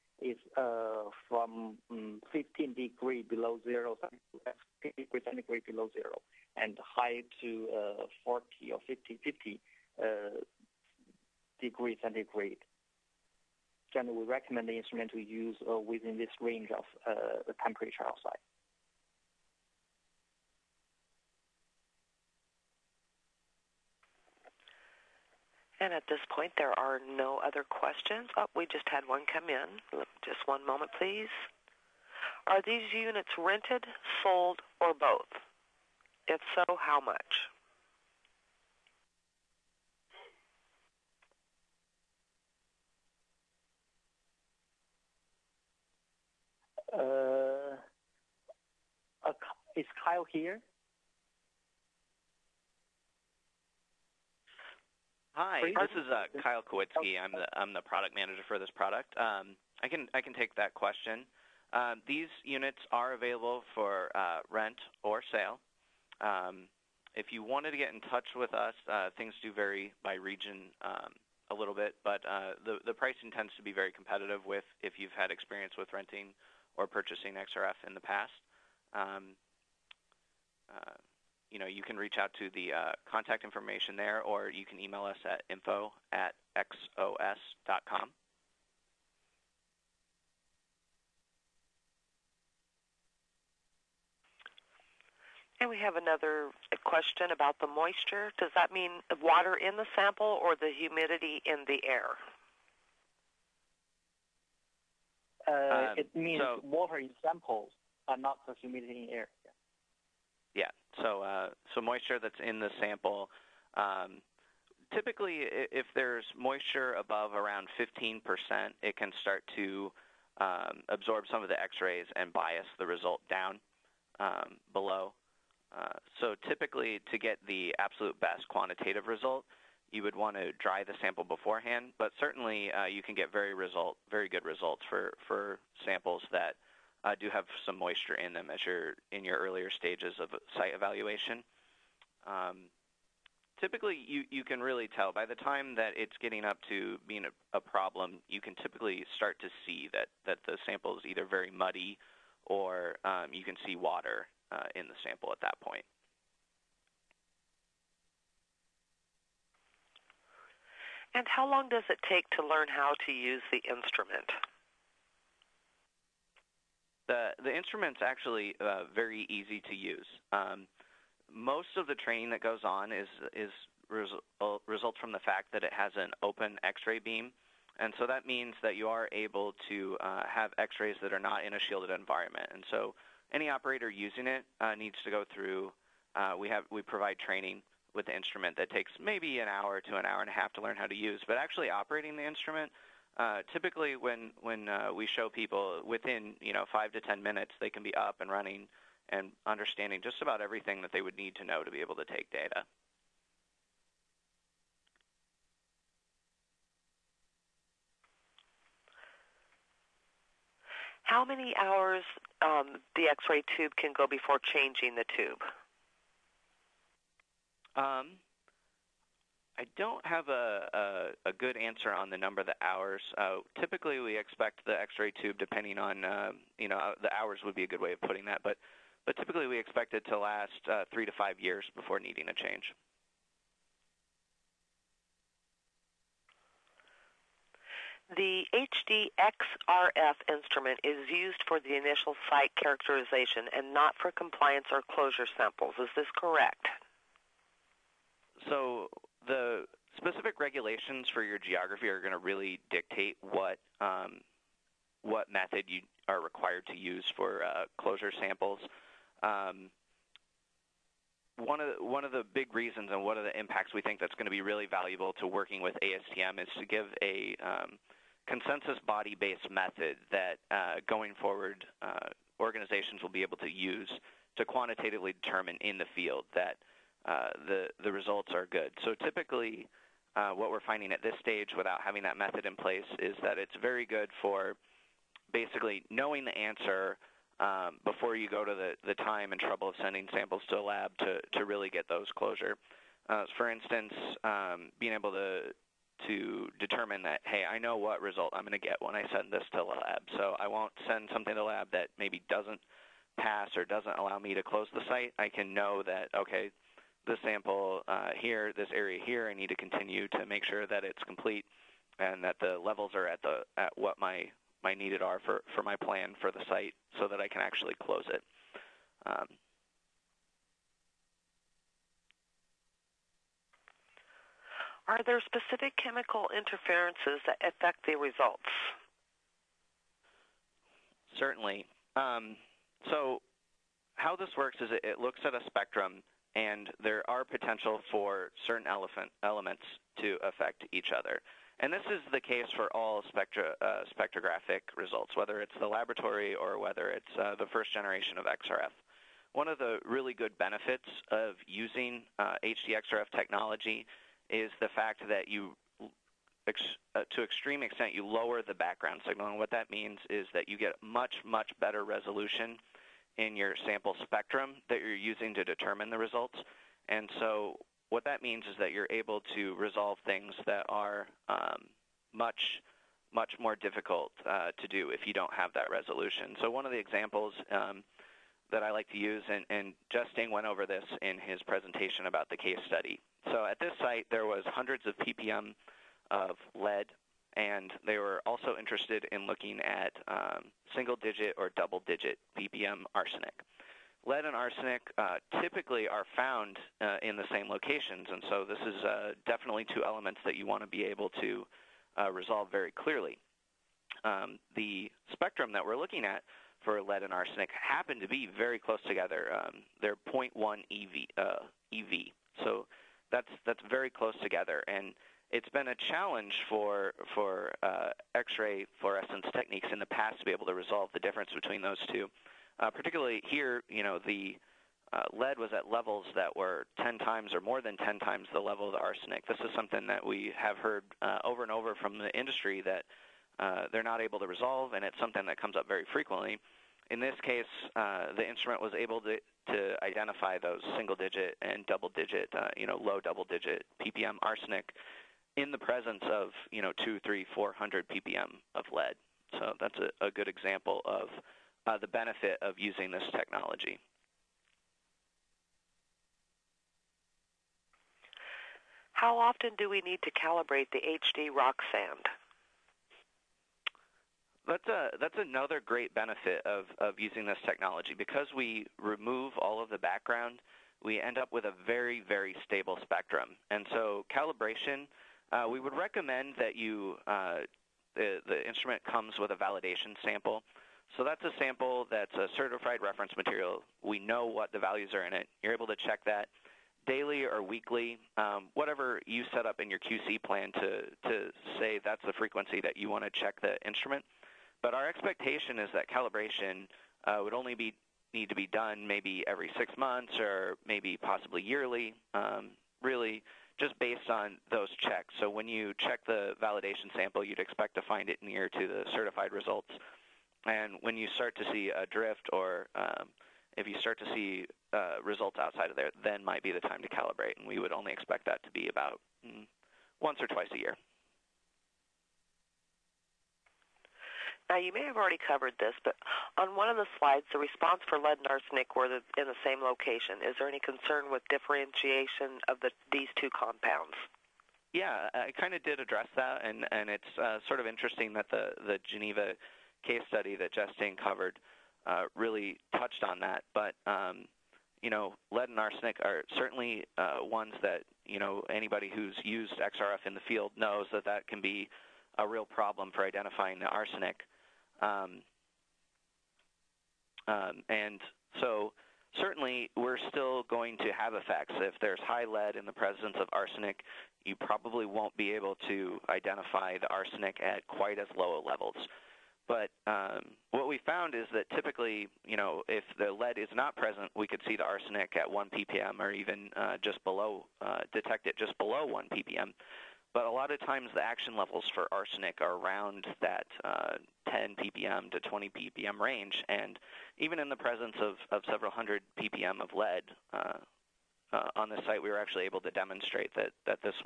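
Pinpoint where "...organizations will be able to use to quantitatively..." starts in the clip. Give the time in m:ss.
4:32.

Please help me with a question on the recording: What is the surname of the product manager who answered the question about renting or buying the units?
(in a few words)
Kowitsky.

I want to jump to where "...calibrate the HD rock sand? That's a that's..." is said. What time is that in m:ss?
7:40.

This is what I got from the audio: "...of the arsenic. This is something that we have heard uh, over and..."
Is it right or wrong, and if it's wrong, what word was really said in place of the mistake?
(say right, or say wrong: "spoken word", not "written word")
right.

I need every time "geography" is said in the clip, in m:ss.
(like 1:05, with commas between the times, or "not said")
4:11.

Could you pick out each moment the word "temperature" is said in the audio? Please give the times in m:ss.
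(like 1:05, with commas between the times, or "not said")
0:17.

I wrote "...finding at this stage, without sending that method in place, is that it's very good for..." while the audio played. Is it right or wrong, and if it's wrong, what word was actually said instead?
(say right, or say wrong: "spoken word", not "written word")
wrong: "having", not "sending".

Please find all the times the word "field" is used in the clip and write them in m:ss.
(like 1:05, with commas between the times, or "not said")
4:35, 9:10.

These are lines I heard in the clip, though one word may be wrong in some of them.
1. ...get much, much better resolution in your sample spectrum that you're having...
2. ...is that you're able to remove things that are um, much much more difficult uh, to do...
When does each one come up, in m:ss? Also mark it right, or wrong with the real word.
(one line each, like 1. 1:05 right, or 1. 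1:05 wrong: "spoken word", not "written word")
1. 6:00 wrong: "using", not "having"
2. 6:08 wrong: "resolve", not "remove".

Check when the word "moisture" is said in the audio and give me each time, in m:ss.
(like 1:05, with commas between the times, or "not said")
1:37, 1:51, 1:56, 2:17.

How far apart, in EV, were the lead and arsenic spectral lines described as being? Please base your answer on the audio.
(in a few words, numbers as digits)
0.1 EV.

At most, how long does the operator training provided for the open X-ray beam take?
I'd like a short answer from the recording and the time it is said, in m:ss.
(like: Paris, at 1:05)
an hour and a half, at 3:09.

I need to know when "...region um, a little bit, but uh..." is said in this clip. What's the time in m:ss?
1:10.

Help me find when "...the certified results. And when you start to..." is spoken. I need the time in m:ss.
8:28.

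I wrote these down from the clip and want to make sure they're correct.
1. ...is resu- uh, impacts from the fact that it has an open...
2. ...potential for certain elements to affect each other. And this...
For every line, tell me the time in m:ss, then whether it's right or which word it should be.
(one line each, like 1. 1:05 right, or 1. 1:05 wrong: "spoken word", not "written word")
1. 2:53 wrong: "results", not "impacts"
2. 5:37 right.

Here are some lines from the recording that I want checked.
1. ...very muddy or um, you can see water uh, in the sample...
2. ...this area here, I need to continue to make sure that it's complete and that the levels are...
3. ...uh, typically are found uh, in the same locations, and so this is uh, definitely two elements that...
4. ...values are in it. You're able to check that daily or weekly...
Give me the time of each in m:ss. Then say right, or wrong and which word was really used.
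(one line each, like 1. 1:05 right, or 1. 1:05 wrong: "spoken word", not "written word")
1. 2:31 right
2. 5:08 right
3. 6:34 right
4. 8:04 right.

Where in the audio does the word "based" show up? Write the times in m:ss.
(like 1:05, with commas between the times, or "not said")
4:28, 8:23.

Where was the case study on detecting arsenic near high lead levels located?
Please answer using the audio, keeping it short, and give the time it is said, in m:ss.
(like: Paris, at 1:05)
Geneva, at 8:58.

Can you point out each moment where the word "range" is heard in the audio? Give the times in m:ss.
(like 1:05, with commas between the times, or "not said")
0:16, 9:45.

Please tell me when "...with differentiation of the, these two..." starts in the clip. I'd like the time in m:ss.
8:51.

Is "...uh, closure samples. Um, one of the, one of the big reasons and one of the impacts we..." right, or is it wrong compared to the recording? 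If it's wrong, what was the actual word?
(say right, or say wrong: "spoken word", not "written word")
right.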